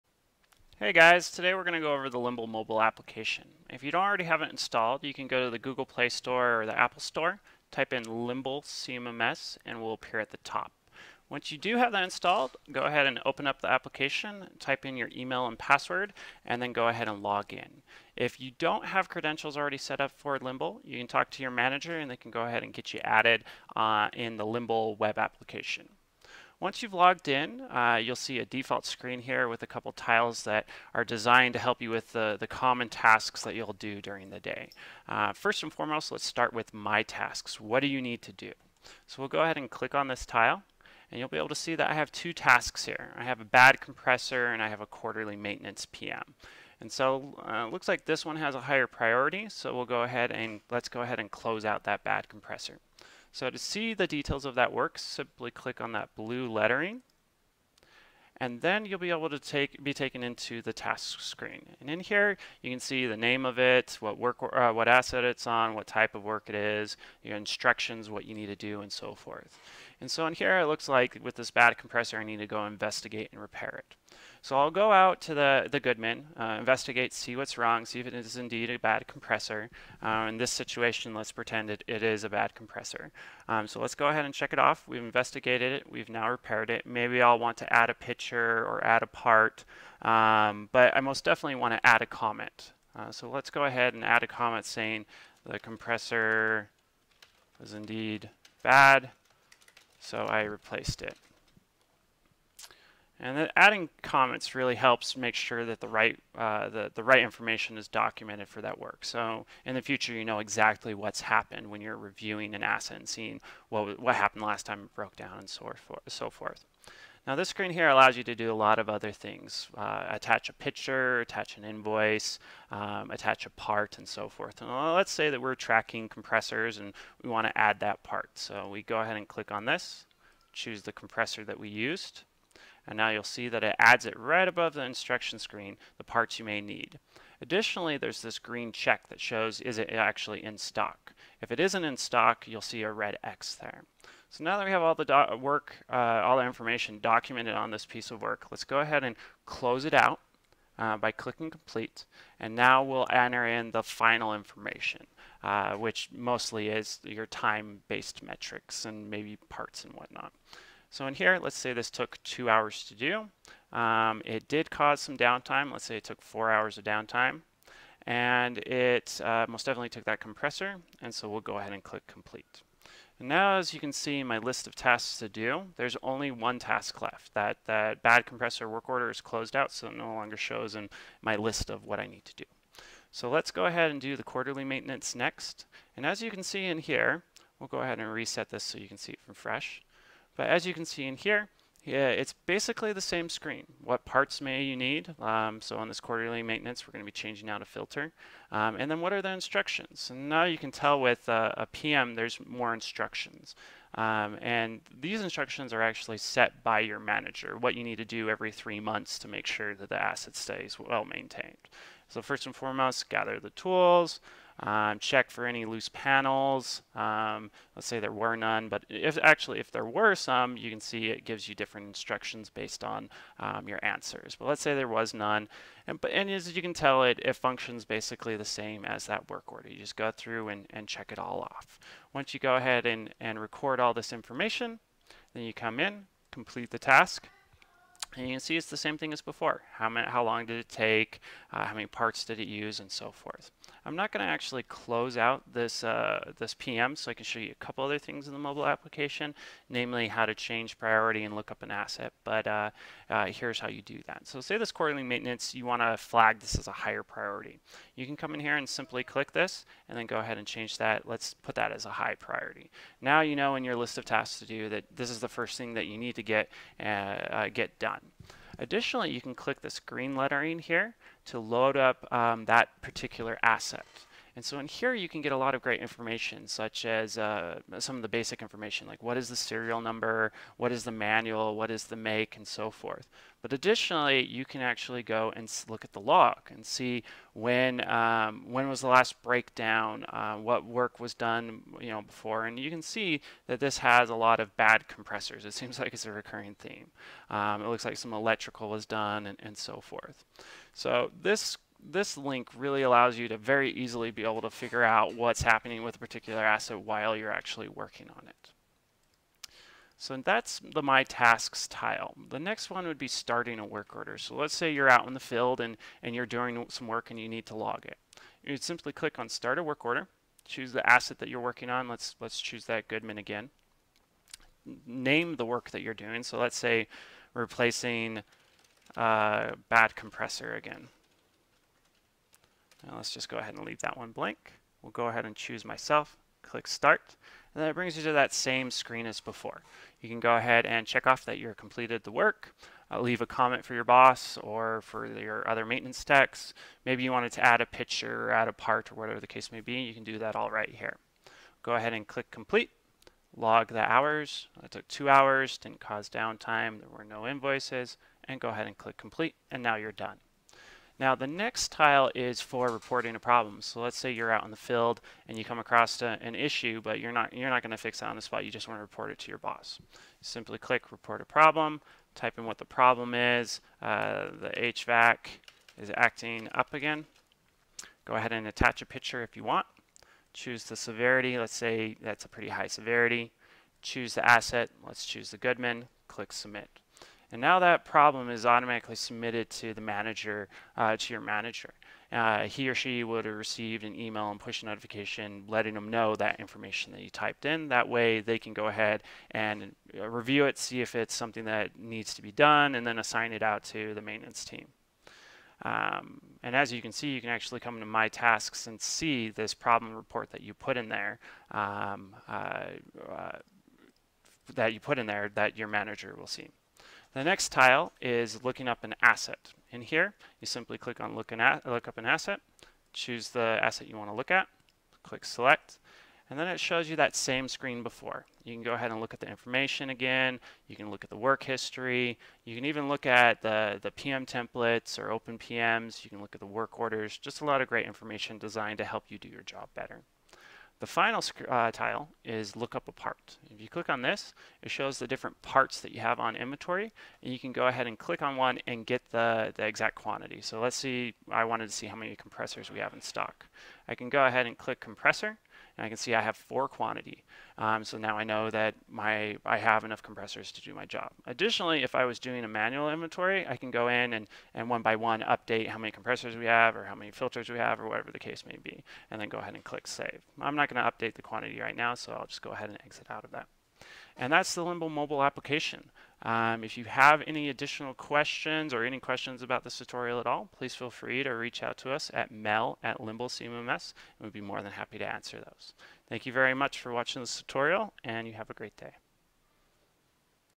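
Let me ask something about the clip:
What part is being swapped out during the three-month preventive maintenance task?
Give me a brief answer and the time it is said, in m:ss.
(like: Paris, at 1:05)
A filter, at 3:17.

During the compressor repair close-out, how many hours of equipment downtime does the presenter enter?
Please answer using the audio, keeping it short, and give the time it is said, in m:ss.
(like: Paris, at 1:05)
4, at 2:46.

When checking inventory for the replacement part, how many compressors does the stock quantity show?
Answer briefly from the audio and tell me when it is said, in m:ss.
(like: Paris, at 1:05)
4, at 7:36.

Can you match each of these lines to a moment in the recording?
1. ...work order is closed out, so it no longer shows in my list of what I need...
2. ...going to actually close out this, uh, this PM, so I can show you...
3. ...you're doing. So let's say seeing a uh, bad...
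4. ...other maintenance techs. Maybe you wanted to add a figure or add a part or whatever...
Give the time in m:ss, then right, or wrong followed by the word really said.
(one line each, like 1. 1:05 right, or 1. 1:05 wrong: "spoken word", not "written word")
1. 2:58 right
2. 4:04 right
3. 5:25 wrong: "replacing", not "seeing"
4. 5:45 wrong: "picture", not "figure".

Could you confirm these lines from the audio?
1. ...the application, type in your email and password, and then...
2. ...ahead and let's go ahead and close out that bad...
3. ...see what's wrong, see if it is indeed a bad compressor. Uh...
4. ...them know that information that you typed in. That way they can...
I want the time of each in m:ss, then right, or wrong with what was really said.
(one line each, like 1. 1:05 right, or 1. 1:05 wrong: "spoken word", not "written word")
1. 0:13 right
2. 0:50 right
3. 1:17 right
4. 6:35 right.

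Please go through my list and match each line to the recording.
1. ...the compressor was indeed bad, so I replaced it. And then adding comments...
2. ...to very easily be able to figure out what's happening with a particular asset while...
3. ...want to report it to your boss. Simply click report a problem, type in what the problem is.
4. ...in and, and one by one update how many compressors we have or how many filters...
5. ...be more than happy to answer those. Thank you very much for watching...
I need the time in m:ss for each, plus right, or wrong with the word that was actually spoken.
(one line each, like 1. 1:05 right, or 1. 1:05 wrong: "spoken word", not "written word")
1. 1:35 right
2. 5:03 right
3. 6:08 right
4. 7:43 right
5. 8:04 right.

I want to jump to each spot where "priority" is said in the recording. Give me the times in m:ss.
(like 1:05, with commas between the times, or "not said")
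0:48, 4:10, 4:17, 4:22.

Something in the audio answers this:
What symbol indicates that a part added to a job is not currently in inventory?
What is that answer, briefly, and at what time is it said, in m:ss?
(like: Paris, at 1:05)
A red X, at 2:22.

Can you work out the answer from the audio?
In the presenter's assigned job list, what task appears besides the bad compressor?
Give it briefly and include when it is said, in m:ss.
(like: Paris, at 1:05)
Quarterly maintenance PM, at 0:44.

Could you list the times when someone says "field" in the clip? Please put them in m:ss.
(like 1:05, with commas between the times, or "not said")
5:15, 6:04.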